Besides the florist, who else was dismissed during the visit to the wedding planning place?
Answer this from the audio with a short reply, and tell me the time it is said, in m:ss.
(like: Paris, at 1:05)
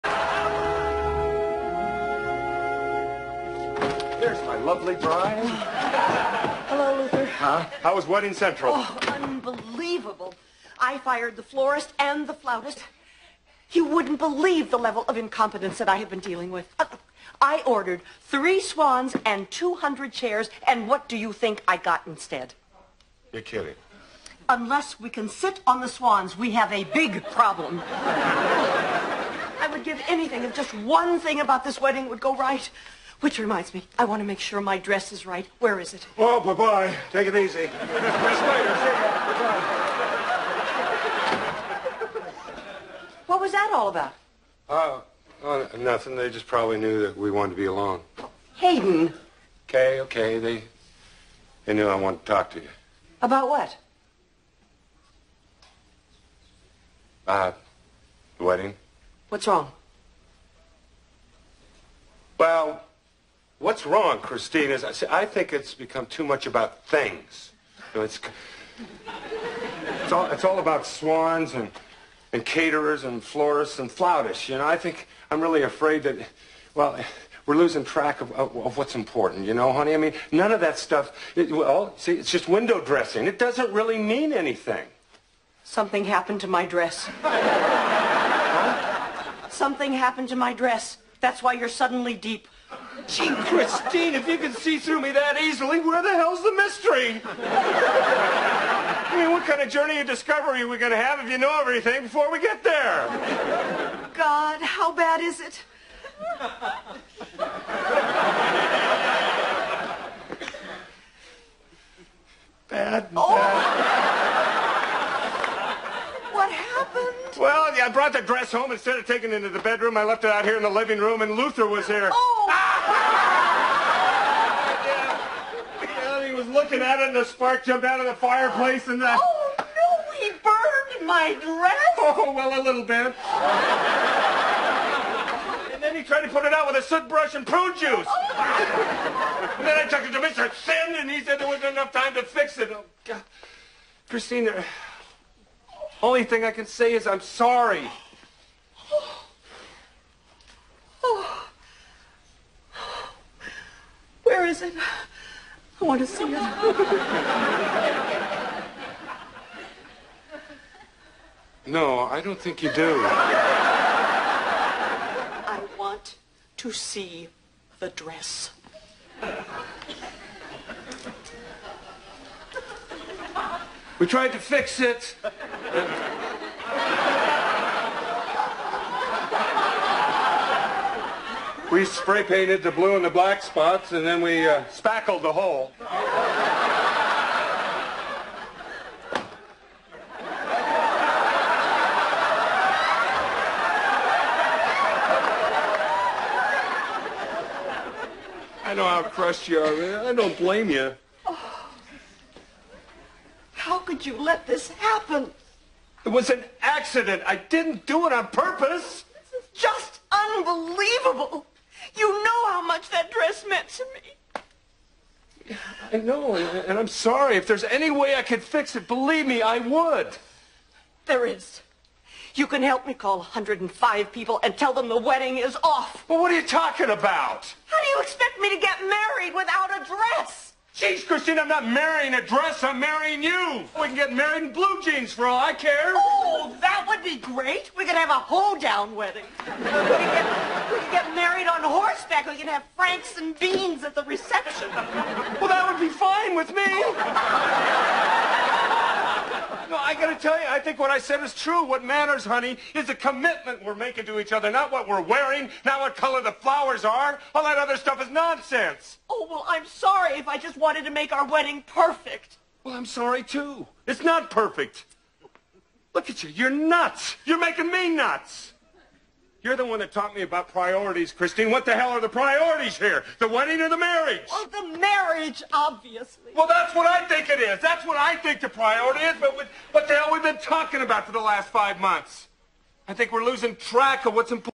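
the flautist, at 0:12.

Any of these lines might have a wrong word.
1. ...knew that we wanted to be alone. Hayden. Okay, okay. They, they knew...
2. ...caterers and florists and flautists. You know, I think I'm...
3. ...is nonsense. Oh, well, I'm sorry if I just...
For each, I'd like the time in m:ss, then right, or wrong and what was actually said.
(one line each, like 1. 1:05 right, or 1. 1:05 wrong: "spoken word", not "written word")
1. 0:46 right
2. 1:12 right
3. 4:18 right.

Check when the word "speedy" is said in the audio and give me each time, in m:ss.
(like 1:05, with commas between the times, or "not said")
not said.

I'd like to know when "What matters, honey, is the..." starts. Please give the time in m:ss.
4:11.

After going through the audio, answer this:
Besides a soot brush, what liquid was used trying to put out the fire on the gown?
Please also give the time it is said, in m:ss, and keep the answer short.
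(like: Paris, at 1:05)
prune juice, at 2:17.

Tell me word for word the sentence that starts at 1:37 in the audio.
I mean, what kind of journey of discovery are we going to have if you know everything before we get there?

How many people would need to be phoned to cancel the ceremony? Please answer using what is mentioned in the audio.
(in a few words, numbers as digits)
105.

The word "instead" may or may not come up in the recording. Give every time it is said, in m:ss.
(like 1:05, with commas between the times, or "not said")
0:22, 1:58.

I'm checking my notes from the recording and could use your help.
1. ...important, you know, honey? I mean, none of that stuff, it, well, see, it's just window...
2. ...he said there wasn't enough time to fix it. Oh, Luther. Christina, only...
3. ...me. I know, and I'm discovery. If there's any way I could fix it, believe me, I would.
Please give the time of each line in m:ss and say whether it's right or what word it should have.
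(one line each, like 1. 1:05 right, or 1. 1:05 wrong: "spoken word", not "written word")
1. 1:18 right
2. 2:21 wrong: "God", not "Luther"
3. 3:33 wrong: "sorry", not "discovery".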